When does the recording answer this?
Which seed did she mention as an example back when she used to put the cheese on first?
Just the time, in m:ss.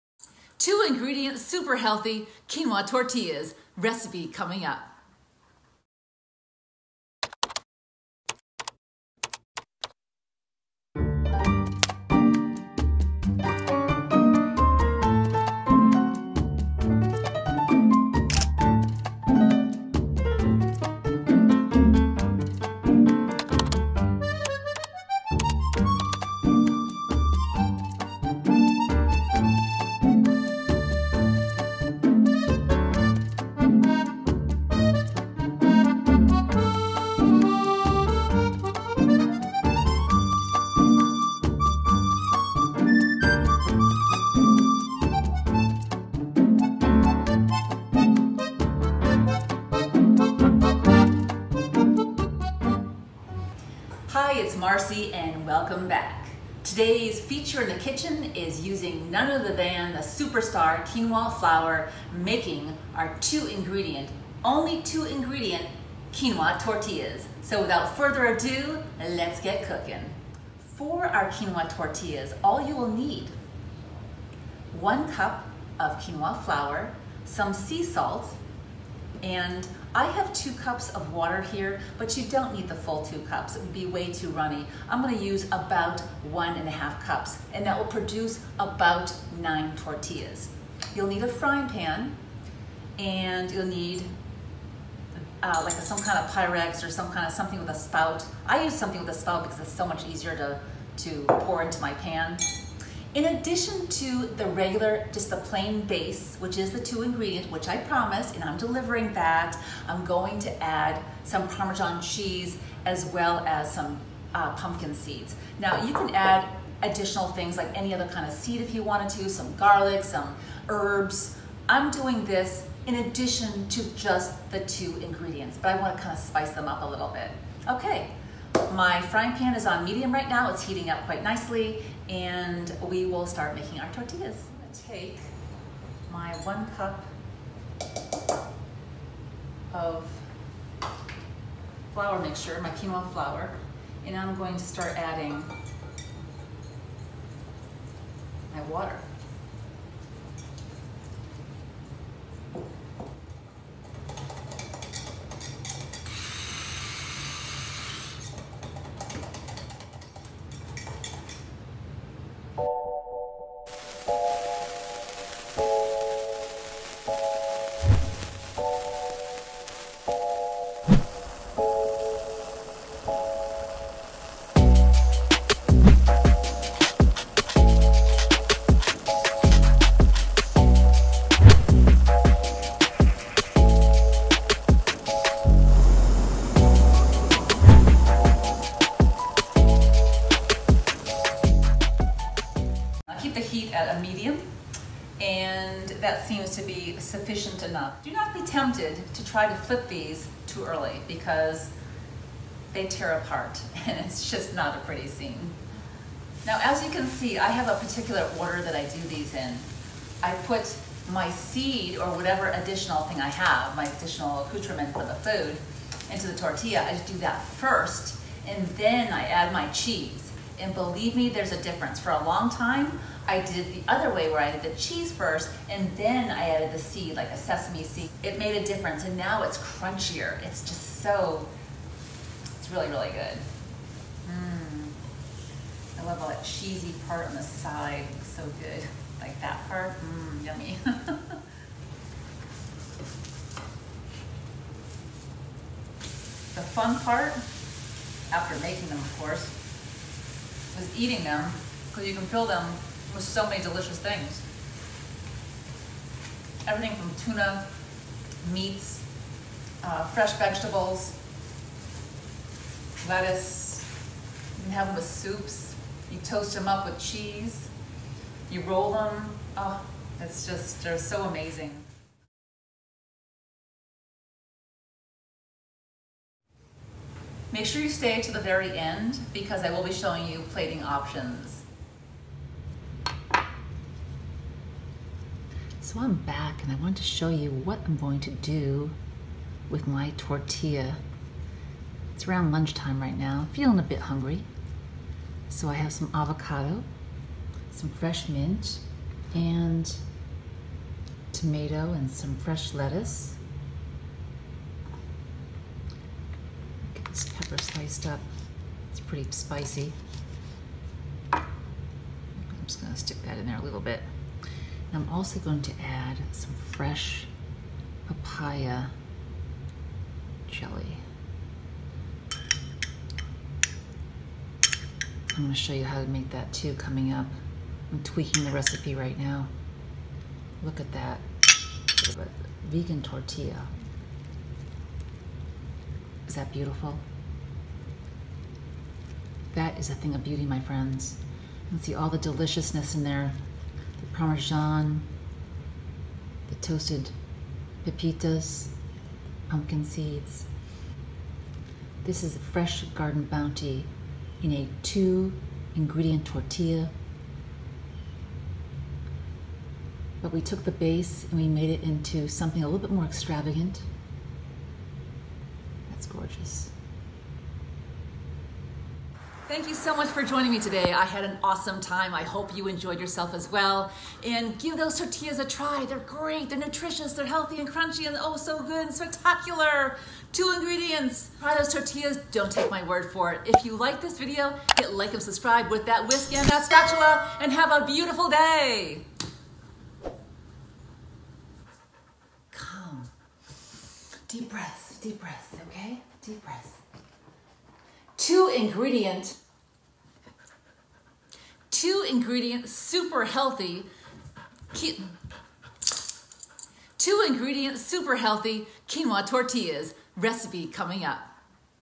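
3:47.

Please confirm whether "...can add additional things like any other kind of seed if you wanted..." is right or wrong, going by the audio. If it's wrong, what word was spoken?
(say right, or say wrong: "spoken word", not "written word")
right.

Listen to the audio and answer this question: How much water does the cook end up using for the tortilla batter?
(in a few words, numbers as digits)
1.5 cups.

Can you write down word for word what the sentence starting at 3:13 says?
heat at a medium and that seems to be sufficient enough.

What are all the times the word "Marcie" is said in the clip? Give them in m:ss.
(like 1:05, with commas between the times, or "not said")
0:54.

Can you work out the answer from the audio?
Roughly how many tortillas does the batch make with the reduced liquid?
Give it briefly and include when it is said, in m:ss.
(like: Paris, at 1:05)
9, at 1:29.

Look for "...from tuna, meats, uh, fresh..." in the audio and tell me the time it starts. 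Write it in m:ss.
4:16.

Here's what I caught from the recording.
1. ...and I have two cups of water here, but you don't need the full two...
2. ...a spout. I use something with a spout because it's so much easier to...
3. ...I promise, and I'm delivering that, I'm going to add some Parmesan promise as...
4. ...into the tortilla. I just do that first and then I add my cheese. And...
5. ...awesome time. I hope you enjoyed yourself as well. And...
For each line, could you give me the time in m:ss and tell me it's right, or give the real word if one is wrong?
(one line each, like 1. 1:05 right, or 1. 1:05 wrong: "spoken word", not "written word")
1. 1:19 right
2. 1:37 right
3. 1:47 wrong: "cheese", not "promise"
4. 3:36 right
5. 6:11 right.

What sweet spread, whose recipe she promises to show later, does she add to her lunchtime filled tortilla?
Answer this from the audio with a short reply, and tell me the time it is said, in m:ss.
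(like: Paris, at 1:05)
papaya jelly, at 5:18.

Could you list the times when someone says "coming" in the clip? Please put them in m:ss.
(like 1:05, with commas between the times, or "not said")
0:04, 5:26, 6:50.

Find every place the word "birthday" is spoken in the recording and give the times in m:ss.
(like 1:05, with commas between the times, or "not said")
not said.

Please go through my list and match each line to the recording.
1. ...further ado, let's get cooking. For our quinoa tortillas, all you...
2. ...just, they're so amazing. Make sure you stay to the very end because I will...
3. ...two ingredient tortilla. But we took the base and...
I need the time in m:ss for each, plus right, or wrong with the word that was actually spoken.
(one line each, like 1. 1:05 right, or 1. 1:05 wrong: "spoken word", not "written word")
1. 1:07 right
2. 4:30 right
3. 5:54 right.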